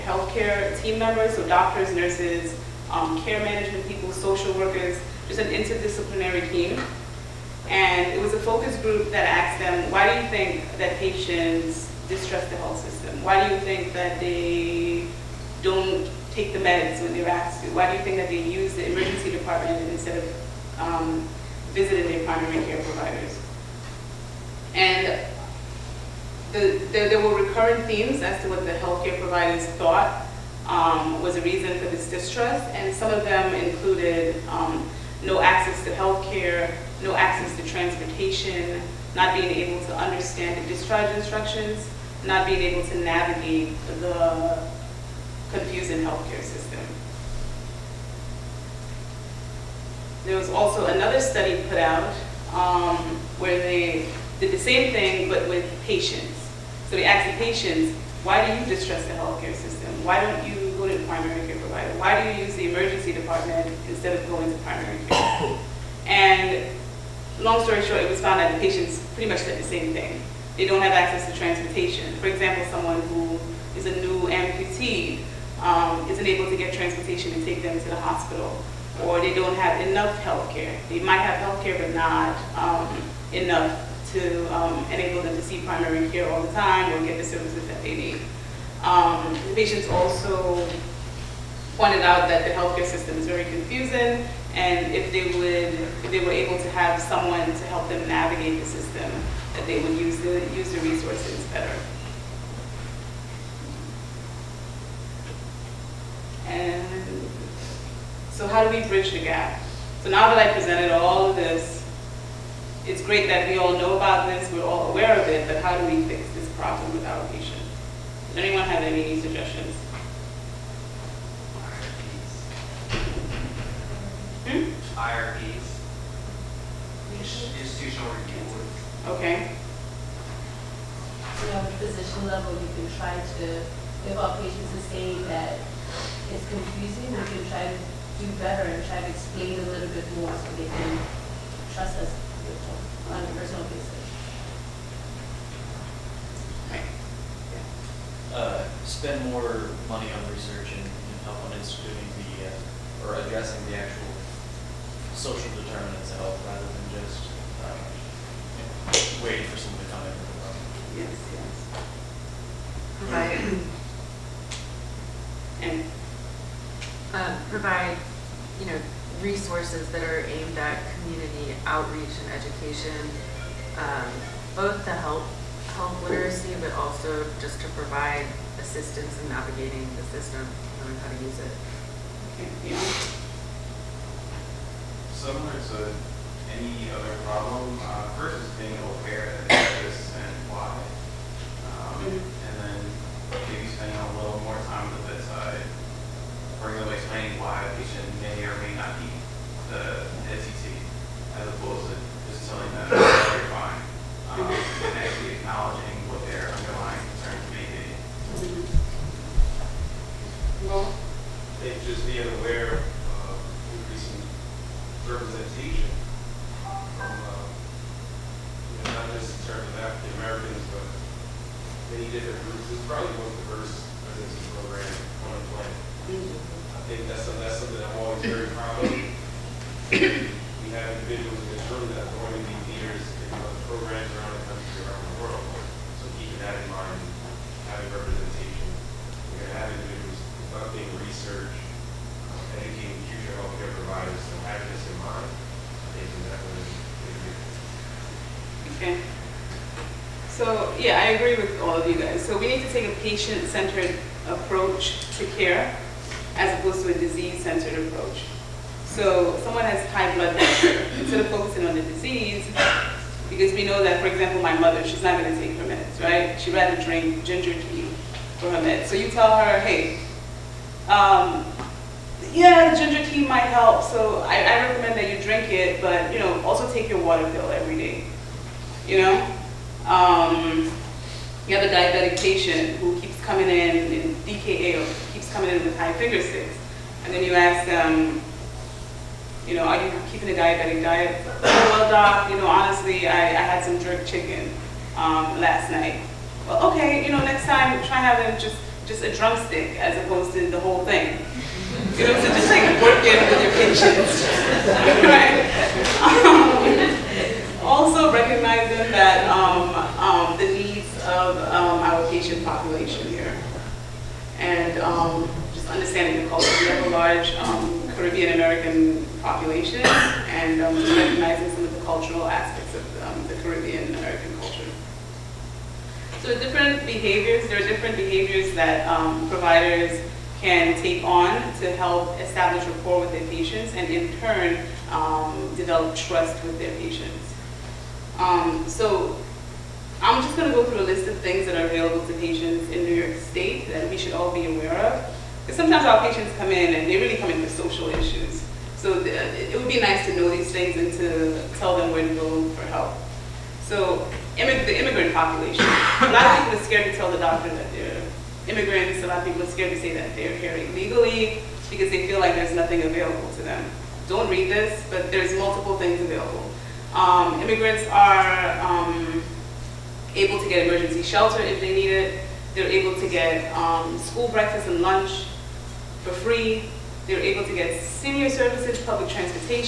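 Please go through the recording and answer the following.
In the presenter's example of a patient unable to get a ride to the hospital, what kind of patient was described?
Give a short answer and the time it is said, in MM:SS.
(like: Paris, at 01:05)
new amputee, at 01:14.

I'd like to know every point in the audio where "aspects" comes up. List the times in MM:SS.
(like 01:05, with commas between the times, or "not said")
05:22.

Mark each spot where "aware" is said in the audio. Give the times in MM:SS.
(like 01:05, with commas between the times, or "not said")
01:54, 03:08, 05:44.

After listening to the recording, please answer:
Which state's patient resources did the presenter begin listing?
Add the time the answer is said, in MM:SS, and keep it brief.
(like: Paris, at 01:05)
New York State, at 05:42.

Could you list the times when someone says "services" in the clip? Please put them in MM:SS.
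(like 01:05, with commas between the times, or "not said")
01:27, 06:18.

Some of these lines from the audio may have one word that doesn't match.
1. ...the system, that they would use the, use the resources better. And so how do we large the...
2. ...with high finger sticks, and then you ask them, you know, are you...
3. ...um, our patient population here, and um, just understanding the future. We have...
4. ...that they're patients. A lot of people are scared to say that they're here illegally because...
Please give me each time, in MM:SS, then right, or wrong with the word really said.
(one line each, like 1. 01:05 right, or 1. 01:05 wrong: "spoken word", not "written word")
1. 01:38 wrong: "bridge", not "large"
2. 04:45 right
3. 05:11 wrong: "culture", not "future"
4. 05:57 wrong: "immigrants", not "patients".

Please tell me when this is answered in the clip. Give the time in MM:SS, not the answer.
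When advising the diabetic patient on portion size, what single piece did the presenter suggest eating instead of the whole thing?
04:59.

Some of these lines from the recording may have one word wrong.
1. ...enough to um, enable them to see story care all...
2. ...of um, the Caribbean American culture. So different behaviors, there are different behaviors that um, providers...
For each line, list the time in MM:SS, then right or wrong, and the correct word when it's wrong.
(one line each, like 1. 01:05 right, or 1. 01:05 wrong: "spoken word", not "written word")
1. 01:23 wrong: "primary", not "story"
2. 05:22 right.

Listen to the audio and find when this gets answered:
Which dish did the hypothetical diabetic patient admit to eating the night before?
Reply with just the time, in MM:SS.
04:53.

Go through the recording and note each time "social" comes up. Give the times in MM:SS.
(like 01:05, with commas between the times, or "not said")
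00:04, 02:35, 05:47.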